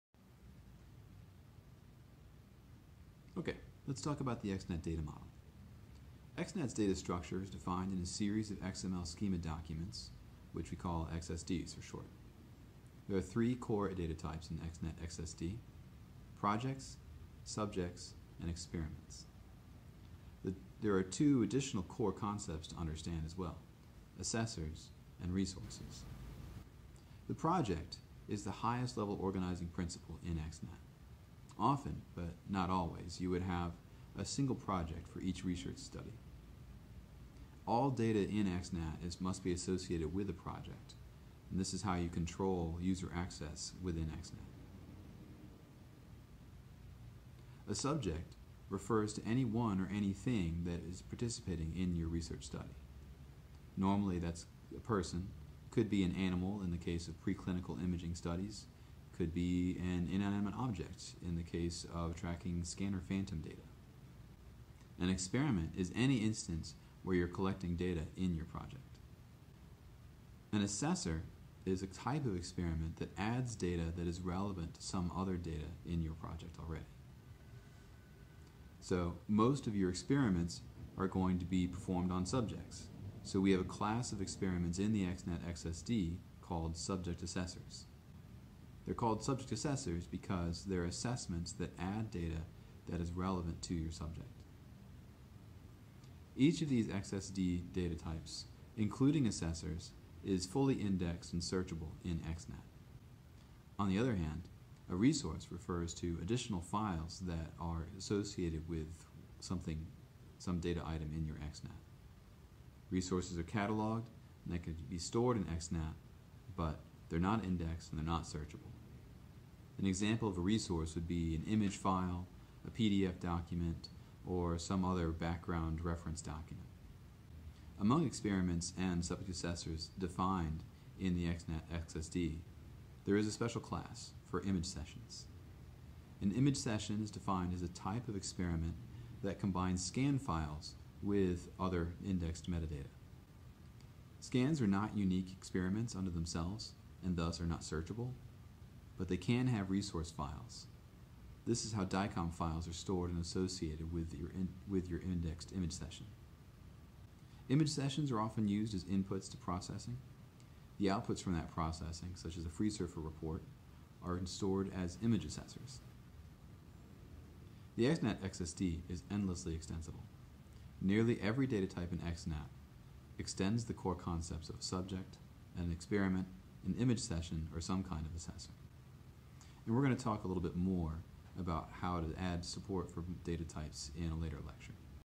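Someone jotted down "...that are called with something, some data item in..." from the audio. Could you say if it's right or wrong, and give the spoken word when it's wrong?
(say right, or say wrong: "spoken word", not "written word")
wrong: "associated", not "called".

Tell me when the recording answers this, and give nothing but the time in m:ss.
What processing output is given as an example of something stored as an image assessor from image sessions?
2:42.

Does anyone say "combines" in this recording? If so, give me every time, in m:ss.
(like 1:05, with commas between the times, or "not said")
2:19.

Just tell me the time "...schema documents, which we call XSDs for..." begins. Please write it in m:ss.
0:09.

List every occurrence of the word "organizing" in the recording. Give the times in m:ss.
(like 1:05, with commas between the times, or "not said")
0:29.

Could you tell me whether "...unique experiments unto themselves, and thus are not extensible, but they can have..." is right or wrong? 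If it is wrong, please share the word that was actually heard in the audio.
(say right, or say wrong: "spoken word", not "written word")
wrong: "searchable", not "extensible".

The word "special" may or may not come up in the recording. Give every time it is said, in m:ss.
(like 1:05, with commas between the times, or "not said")
2:13.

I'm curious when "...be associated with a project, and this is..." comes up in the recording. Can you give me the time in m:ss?
0:39.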